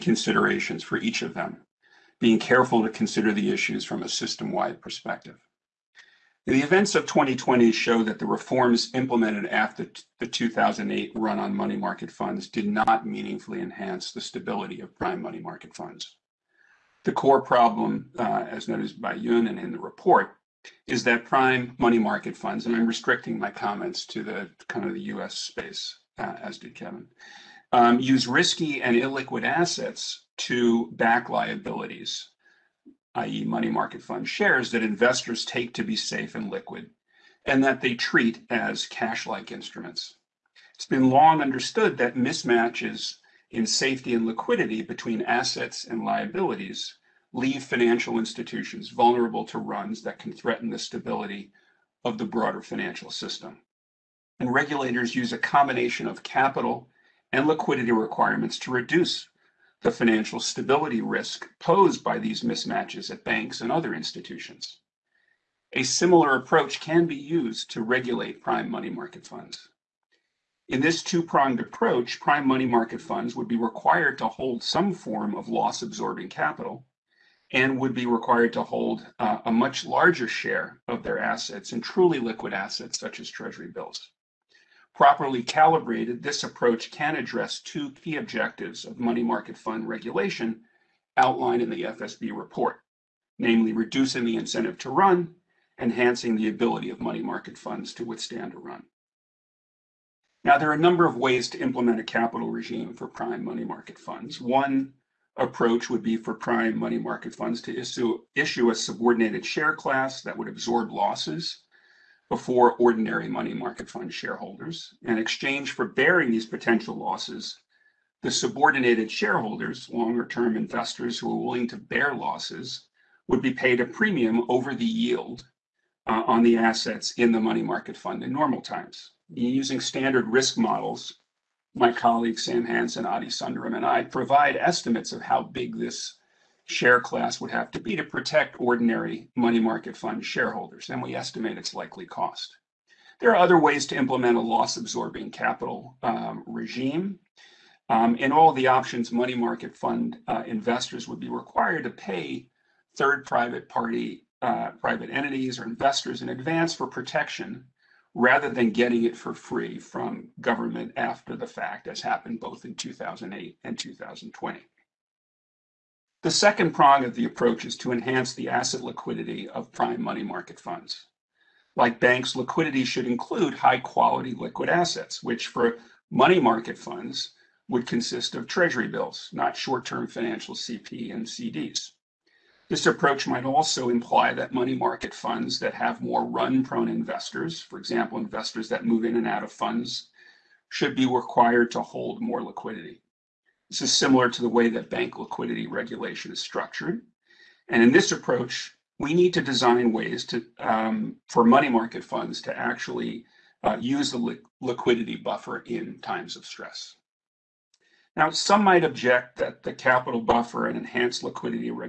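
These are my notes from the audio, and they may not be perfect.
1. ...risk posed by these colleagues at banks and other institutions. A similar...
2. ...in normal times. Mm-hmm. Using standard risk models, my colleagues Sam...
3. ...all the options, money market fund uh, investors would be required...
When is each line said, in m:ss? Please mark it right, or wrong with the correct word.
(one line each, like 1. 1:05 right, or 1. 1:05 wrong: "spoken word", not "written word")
1. 1:00 wrong: "mismatches", not "colleagues"
2. 2:08 right
3. 2:28 right.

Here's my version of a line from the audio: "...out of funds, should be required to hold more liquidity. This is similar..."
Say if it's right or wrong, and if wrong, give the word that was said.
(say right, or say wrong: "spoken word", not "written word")
right.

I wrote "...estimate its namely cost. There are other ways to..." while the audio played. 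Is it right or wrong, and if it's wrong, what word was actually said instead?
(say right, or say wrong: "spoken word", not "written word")
wrong: "likely", not "namely".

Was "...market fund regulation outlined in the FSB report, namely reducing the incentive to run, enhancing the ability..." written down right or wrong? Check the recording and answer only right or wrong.
right.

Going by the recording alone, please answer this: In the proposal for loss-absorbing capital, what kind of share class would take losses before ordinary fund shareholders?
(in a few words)
subordinated share class.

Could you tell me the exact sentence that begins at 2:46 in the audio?
The second prong of the approach is to enhance the asset liquidity of prime money market funds.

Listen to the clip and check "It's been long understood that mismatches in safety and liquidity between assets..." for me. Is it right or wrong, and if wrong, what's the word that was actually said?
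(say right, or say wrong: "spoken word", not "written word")
right.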